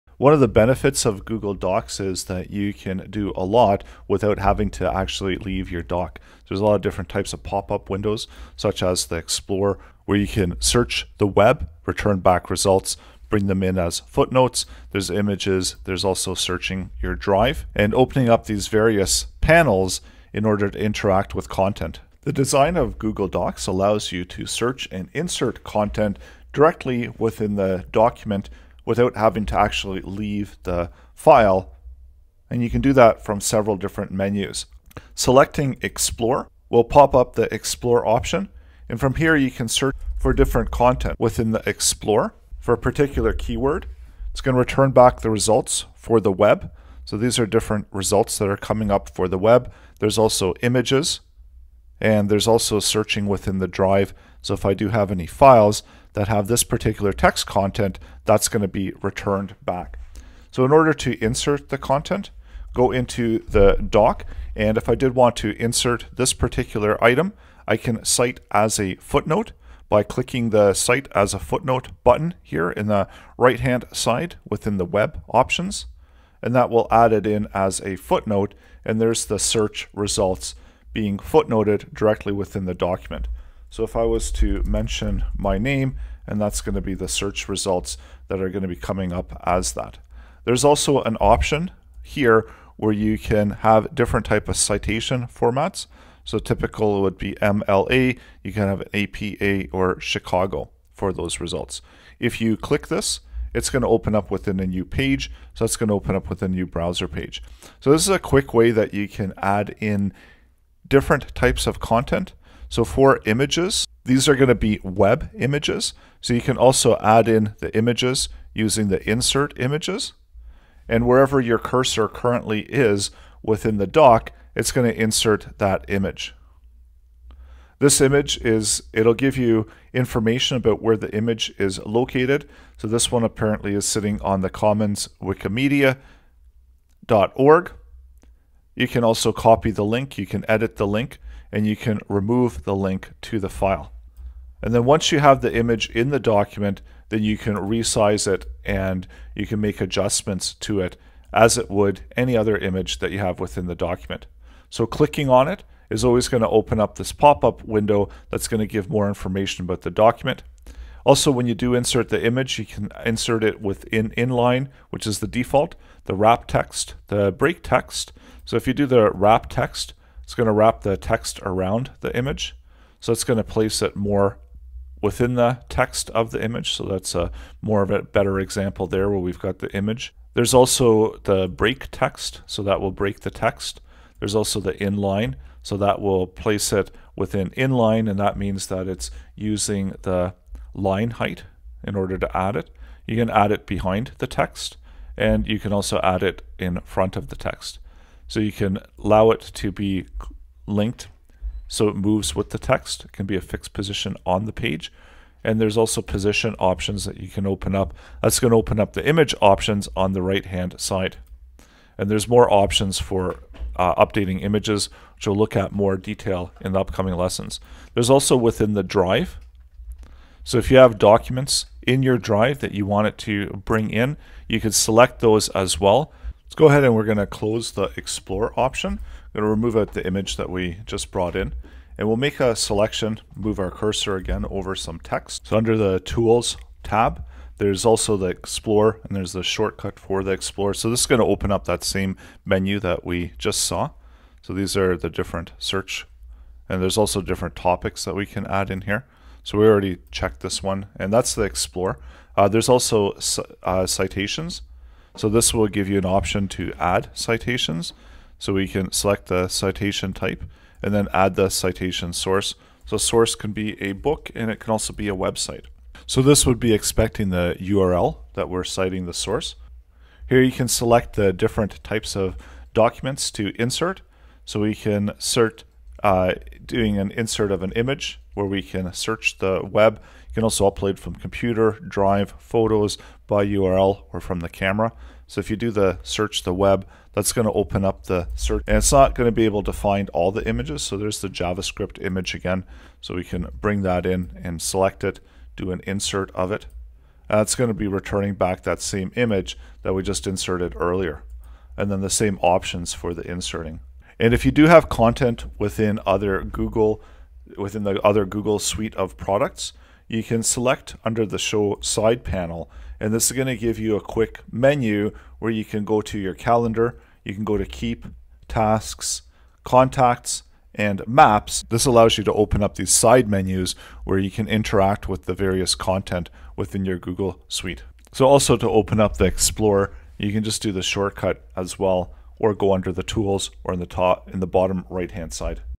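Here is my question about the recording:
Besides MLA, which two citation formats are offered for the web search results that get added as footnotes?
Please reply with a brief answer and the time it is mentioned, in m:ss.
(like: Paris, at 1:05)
APA or Chicago, at 1:38.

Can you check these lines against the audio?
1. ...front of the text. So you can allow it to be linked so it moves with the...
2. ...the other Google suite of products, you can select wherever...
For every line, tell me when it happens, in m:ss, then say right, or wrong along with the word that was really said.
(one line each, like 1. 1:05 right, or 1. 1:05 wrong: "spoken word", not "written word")
1. 3:16 right
2. 5:07 wrong: "under", not "wherever".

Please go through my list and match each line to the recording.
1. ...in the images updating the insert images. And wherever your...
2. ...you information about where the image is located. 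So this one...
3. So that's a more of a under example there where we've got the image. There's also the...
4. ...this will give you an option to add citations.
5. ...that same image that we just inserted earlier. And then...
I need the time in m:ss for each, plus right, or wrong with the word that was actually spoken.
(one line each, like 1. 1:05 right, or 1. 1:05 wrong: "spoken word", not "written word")
1. 1:57 wrong: "using", not "updating"
2. 2:09 right
3. 2:56 wrong: "better", not "under"
4. 4:15 right
5. 4:58 right.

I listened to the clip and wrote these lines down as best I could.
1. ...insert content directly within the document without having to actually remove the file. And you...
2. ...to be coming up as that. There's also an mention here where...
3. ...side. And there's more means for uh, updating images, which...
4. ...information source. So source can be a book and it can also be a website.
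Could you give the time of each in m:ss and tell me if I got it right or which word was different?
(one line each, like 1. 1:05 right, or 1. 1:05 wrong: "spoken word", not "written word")
1. 0:25 wrong: "leave", not "remove"
2. 1:28 wrong: "option", not "mention"
3. 3:30 wrong: "options", not "means"
4. 4:21 wrong: "citation", not "information".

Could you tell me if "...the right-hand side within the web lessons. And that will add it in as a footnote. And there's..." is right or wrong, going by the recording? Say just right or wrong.
wrong.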